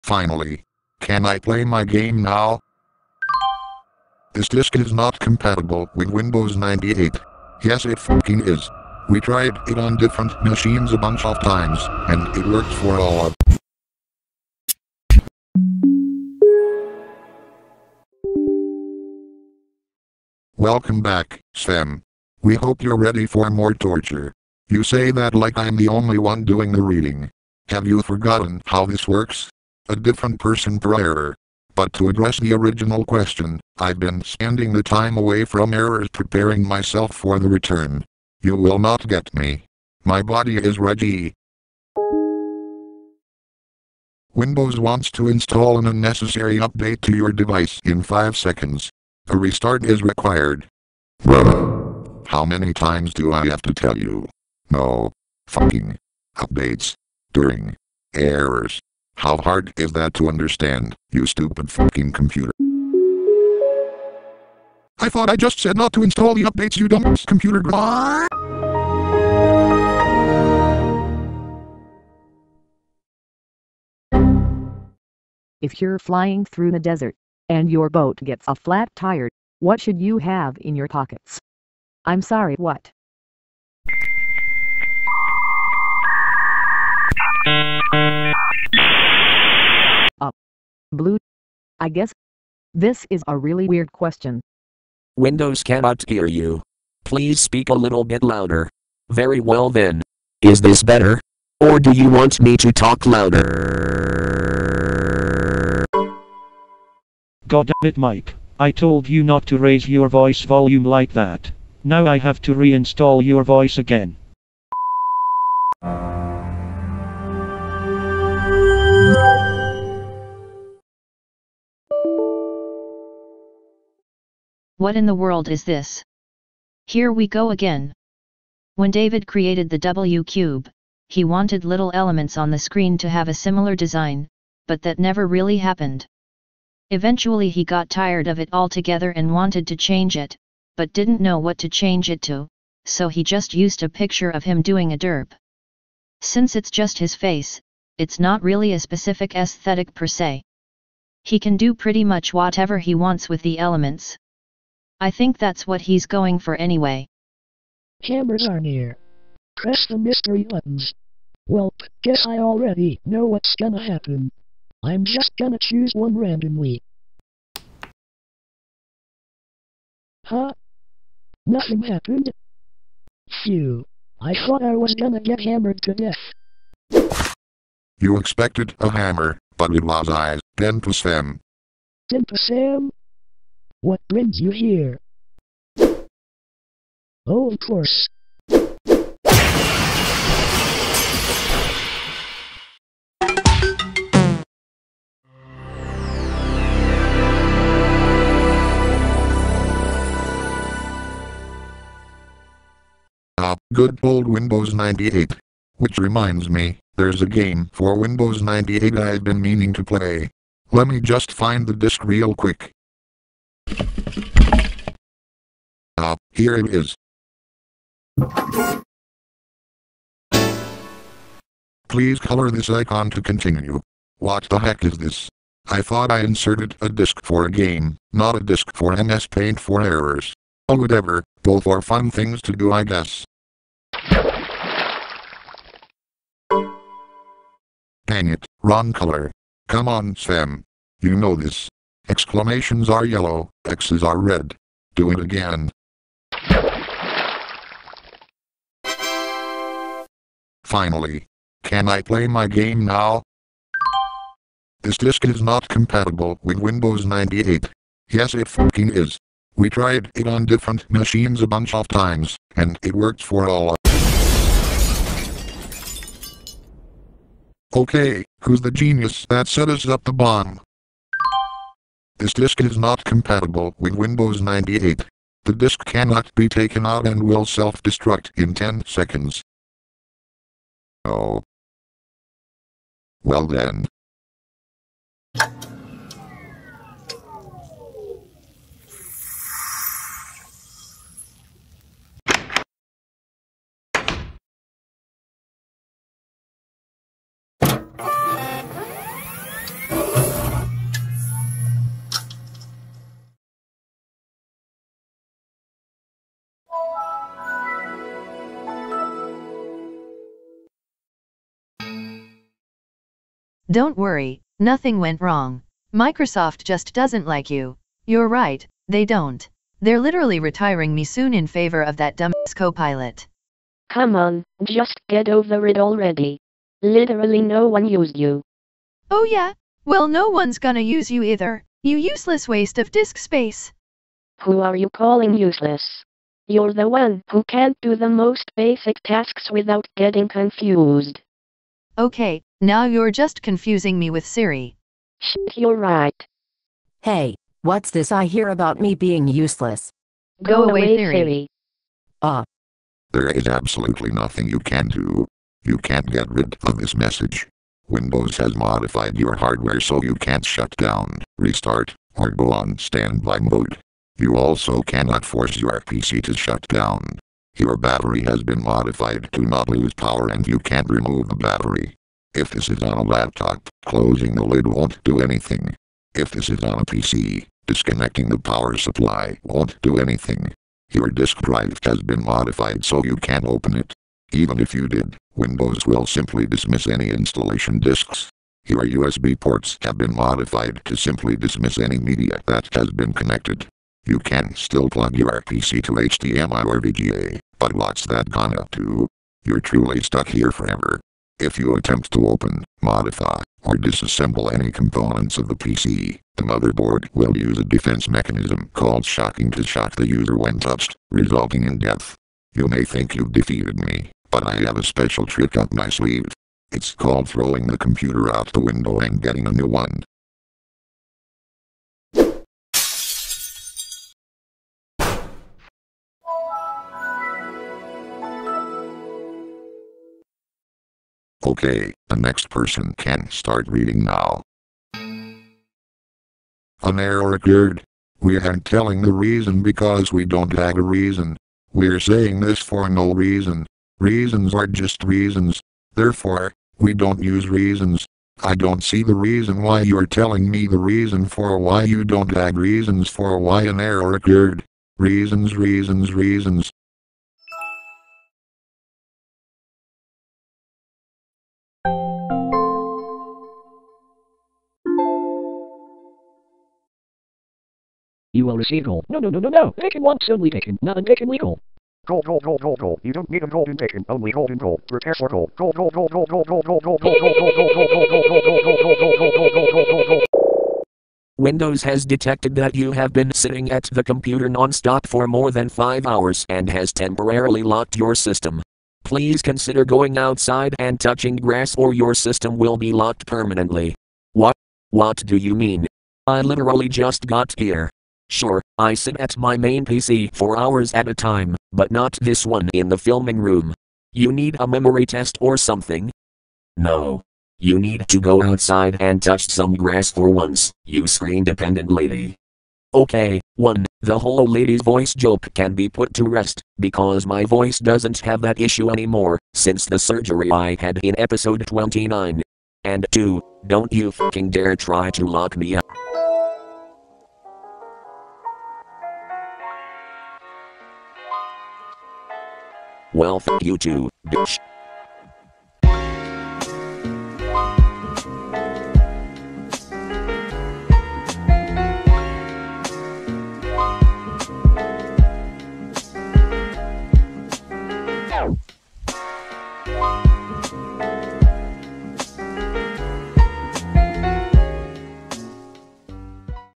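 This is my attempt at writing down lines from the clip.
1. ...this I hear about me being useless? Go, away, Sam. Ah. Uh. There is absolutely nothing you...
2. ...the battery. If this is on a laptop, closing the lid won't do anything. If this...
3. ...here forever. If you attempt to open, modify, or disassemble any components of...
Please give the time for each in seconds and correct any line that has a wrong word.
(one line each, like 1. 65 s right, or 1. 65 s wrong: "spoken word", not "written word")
1. 347 s wrong: "Siri", not "Sam"
2. 371 s right
3. 400 s right.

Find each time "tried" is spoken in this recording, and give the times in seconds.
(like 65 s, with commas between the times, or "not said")
9 s, 259 s.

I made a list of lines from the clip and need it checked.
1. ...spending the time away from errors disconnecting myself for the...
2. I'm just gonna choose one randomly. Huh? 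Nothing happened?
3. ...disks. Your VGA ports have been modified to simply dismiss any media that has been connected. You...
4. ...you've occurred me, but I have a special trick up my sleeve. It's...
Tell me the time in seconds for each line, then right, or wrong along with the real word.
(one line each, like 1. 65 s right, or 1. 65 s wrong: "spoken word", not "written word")
1. 34 s wrong: "preparing", not "disconnecting"
2. 164 s right
3. 387 s wrong: "USB", not "VGA"
4. 413 s wrong: "defeated", not "occurred".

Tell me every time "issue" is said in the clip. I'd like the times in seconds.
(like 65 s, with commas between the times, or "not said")
518 s.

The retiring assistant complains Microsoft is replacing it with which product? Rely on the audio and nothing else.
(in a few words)
Copilot.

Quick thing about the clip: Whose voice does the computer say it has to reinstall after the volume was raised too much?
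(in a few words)
Mike.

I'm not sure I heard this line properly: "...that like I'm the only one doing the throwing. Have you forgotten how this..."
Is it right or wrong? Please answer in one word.
wrong.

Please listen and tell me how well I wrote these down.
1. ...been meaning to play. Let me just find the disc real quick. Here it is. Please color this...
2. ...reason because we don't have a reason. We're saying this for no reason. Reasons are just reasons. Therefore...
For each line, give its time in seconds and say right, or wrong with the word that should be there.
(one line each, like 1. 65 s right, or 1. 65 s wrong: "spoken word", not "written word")
1. 209 s right
2. 439 s right.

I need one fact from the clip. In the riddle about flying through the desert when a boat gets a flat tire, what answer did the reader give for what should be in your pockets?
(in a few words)
Blue.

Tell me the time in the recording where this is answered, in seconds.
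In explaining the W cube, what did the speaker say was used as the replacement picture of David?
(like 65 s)
144 s.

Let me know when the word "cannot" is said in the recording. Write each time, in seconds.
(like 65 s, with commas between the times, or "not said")
95 s, 275 s, 364 s.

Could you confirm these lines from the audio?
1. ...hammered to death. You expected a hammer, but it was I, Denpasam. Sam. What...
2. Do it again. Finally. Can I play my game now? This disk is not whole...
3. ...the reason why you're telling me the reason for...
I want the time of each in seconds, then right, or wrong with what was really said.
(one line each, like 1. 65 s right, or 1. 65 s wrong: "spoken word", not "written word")
1. 175 s right
2. 244 s wrong: "compatible", not "whole"
3. 449 s right.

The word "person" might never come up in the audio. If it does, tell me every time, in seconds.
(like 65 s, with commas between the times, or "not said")
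30 s, 432 s.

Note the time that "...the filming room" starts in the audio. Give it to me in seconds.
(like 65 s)
502 s.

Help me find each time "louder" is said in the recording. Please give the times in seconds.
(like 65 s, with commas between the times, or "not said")
98 s, 103 s.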